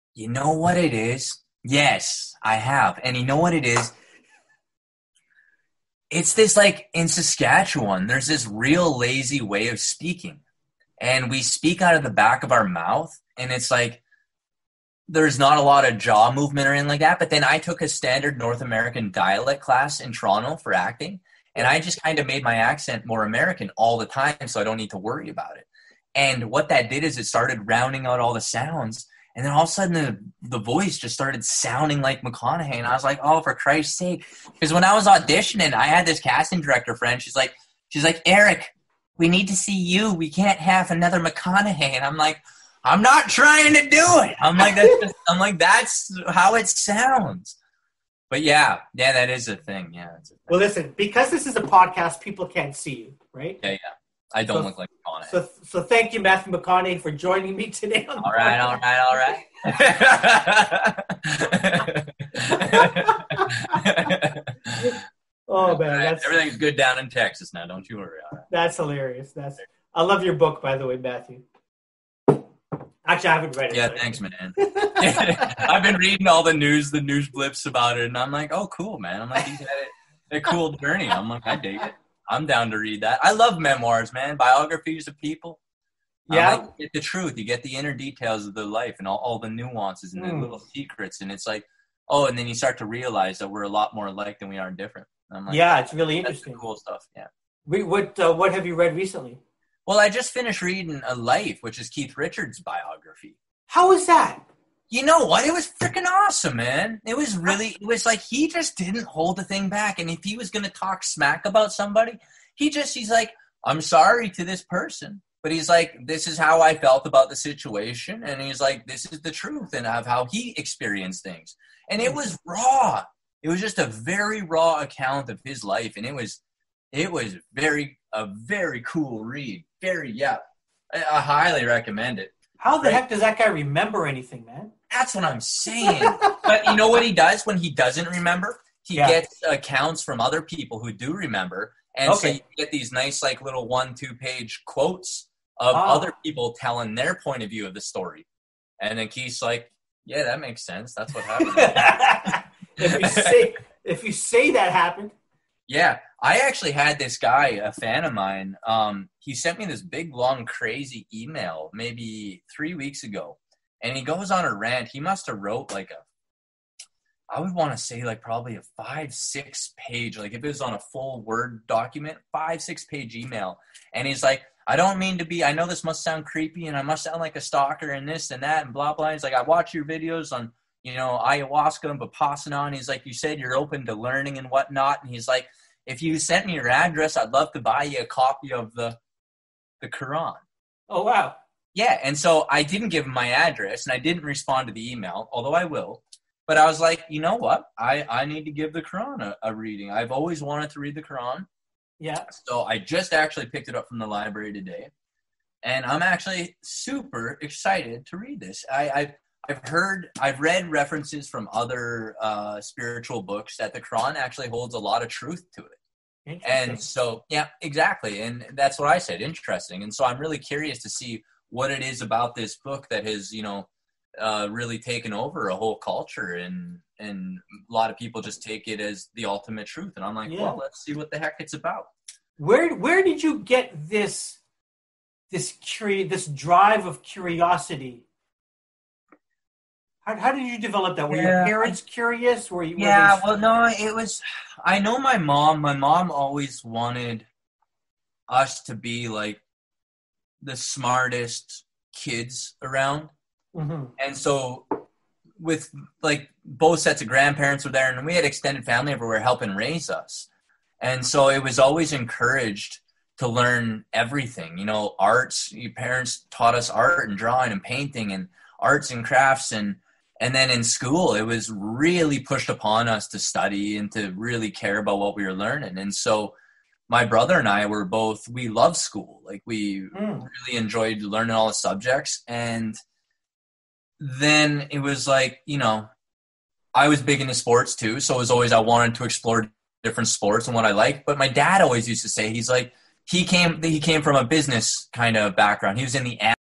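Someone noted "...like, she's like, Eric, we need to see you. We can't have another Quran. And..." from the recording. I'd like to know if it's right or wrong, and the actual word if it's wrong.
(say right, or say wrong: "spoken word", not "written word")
wrong: "McConaughey", not "Quran".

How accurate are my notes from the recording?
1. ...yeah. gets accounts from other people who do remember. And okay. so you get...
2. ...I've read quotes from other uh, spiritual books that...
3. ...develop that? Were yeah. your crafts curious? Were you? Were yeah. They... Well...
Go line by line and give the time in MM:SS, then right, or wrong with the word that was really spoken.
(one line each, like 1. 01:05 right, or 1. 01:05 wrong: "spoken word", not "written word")
1. 02:18 right
2. 03:30 wrong: "references", not "quotes"
3. 04:00 wrong: "parents", not "crafts".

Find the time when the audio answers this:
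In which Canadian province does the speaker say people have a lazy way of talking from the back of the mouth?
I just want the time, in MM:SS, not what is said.
00:07.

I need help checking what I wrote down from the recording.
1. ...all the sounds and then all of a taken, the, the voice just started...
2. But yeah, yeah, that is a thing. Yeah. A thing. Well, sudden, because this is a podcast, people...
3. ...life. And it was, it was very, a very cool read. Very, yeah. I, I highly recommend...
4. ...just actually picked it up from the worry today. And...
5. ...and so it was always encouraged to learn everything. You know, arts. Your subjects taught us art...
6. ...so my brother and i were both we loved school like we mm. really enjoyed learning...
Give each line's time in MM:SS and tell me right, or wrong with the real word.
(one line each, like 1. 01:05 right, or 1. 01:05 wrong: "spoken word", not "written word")
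1. 00:28 wrong: "sudden", not "taken"
2. 00:48 wrong: "listen", not "sudden"
3. 02:05 right
4. 03:22 wrong: "library", not "worry"
5. 04:20 wrong: "parents", not "subjects"
6. 04:35 right.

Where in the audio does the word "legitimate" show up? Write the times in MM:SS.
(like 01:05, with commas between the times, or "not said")
not said.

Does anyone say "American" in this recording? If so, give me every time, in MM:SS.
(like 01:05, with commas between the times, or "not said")
00:18, 00:23.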